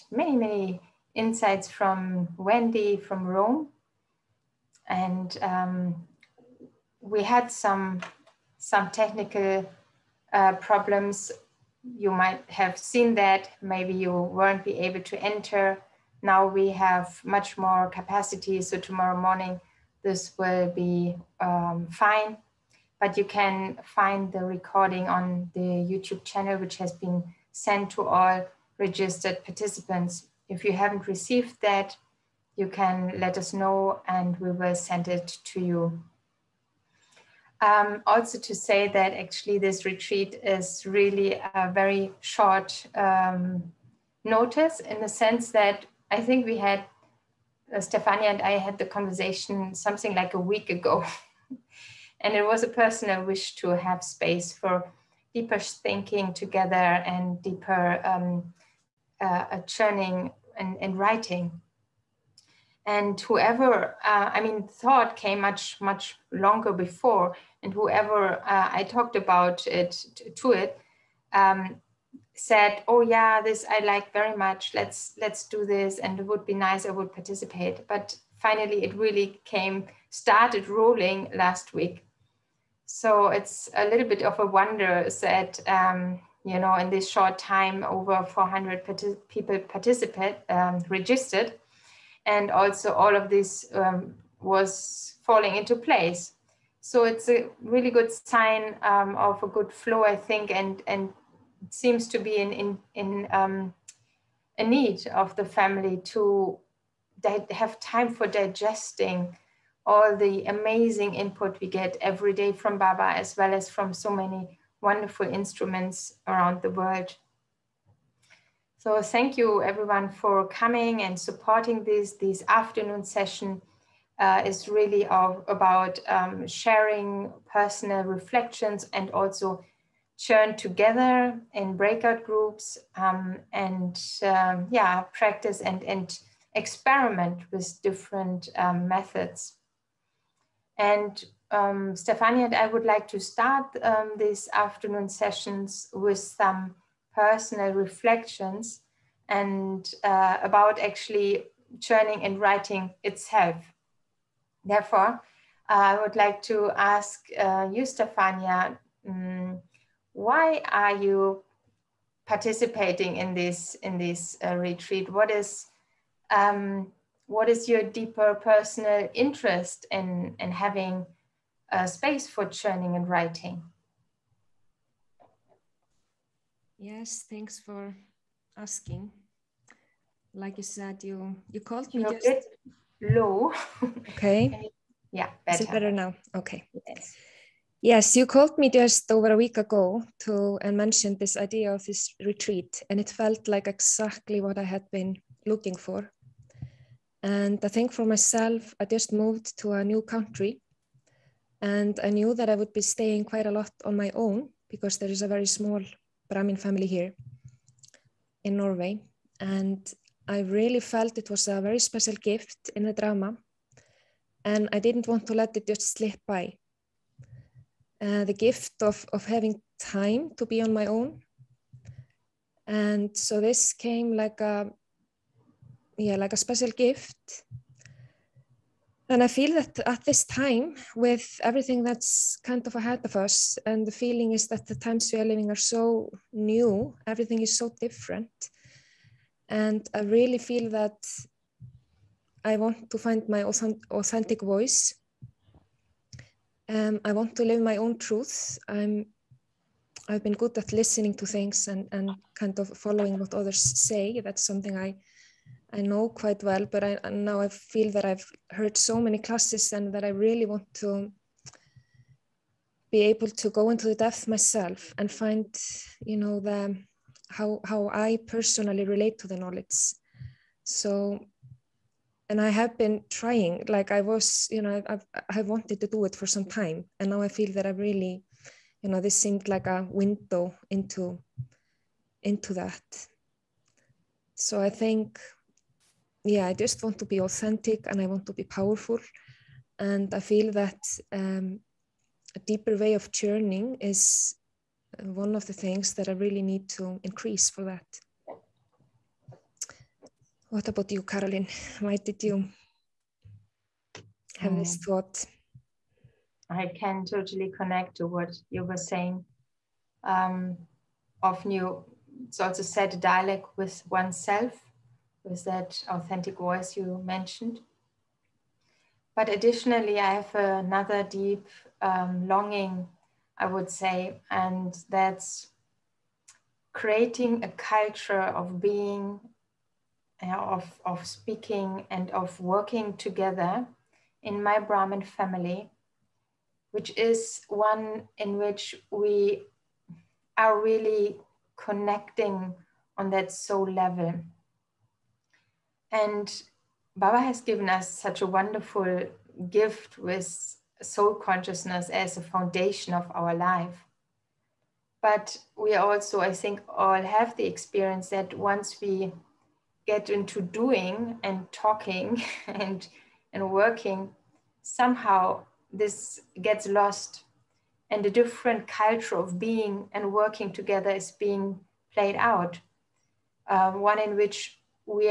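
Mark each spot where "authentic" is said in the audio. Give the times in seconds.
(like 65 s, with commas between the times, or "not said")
243 s, 287 s, 315 s.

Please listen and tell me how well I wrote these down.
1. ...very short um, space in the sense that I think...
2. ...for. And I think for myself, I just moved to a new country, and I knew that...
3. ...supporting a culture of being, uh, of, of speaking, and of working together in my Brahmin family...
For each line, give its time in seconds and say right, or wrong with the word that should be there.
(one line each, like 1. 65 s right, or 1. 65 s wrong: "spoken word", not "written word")
1. 41 s wrong: "notice", not "space"
2. 195 s right
3. 326 s wrong: "creating", not "supporting".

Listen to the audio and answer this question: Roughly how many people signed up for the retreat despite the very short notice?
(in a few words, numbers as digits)
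over 400.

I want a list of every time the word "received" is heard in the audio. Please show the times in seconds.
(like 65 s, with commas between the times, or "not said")
31 s.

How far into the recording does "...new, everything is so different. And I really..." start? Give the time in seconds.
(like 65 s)
236 s.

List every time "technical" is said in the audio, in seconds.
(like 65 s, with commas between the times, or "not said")
8 s.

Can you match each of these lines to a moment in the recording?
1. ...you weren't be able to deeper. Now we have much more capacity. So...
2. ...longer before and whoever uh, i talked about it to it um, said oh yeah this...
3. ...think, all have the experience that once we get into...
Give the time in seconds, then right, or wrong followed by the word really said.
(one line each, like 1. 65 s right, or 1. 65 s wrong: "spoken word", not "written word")
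1. 13 s wrong: "enter", not "deeper"
2. 66 s right
3. 356 s right.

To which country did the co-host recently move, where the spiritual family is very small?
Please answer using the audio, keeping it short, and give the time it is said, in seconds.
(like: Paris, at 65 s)
Norway, at 208 s.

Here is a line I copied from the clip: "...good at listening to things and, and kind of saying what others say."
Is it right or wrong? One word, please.
wrong.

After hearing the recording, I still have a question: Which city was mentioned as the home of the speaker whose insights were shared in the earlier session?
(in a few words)
Rome.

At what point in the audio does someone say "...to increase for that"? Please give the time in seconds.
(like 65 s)
296 s.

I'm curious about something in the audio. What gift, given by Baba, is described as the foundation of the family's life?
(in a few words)
soul consciousness.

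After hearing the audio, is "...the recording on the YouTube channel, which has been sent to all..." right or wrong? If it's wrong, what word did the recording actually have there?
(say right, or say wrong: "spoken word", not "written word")
right.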